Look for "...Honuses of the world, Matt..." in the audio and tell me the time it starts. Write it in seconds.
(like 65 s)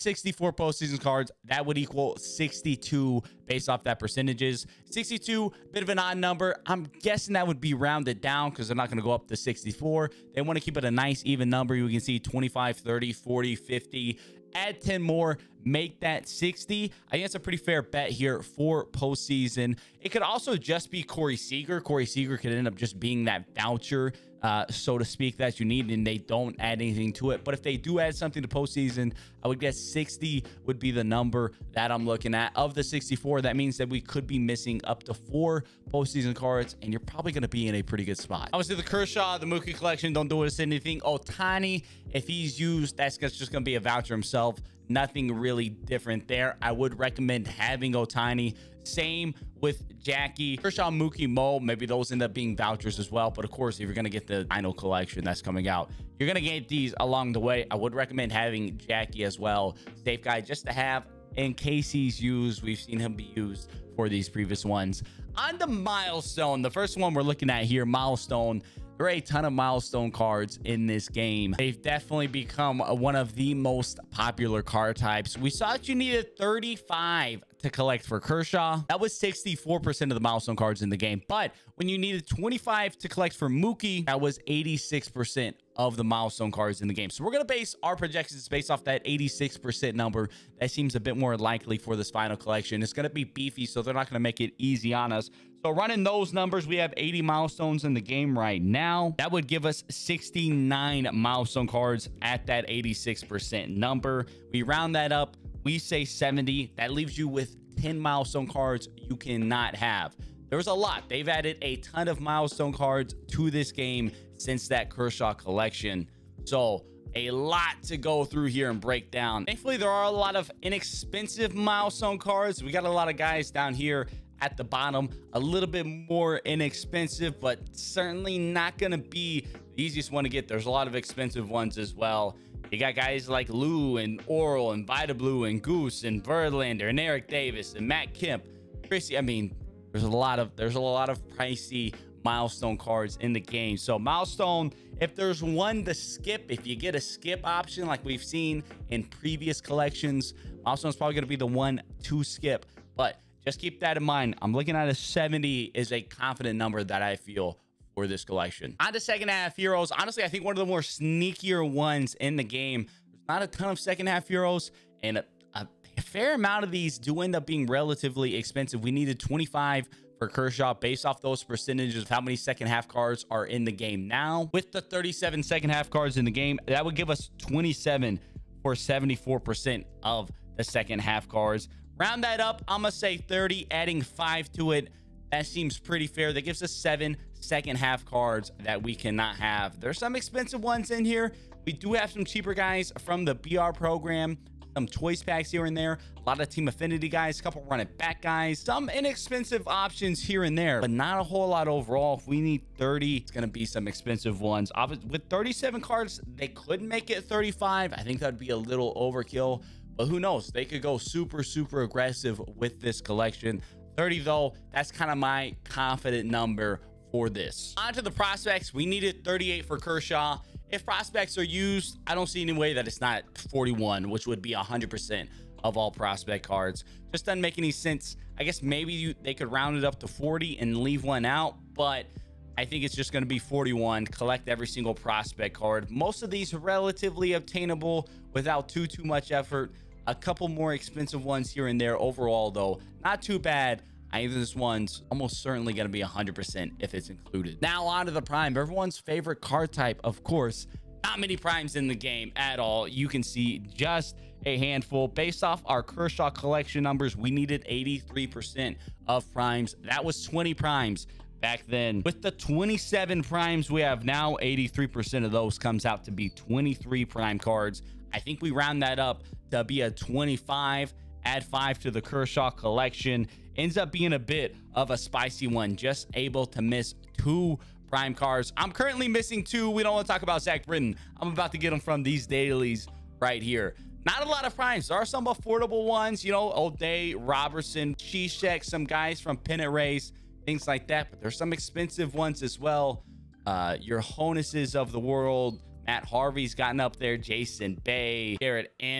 294 s.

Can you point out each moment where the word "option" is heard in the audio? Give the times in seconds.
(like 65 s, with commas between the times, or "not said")
147 s, 199 s.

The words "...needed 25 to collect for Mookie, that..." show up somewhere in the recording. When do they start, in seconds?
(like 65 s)
81 s.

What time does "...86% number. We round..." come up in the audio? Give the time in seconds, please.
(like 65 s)
102 s.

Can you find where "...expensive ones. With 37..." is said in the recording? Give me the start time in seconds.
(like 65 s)
203 s.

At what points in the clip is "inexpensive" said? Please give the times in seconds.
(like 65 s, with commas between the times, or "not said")
120 s, 126 s, 198 s.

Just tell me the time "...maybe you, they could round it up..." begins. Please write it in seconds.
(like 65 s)
228 s.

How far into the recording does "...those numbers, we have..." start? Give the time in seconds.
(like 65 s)
96 s.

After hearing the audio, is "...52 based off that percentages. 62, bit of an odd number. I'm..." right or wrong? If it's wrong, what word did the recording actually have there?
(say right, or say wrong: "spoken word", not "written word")
wrong: "62", not "52".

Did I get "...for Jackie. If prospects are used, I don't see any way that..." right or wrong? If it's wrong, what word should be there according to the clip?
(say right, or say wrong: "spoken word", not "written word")
wrong: "Kershaw", not "Jackie".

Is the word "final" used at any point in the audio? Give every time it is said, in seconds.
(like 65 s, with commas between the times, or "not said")
54 s, 92 s.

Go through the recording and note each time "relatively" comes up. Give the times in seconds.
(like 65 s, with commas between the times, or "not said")
167 s, 236 s.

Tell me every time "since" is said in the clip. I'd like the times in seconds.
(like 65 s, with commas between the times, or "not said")
114 s.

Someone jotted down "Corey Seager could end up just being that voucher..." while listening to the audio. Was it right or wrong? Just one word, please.
right.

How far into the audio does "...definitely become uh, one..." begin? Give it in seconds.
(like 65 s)
71 s.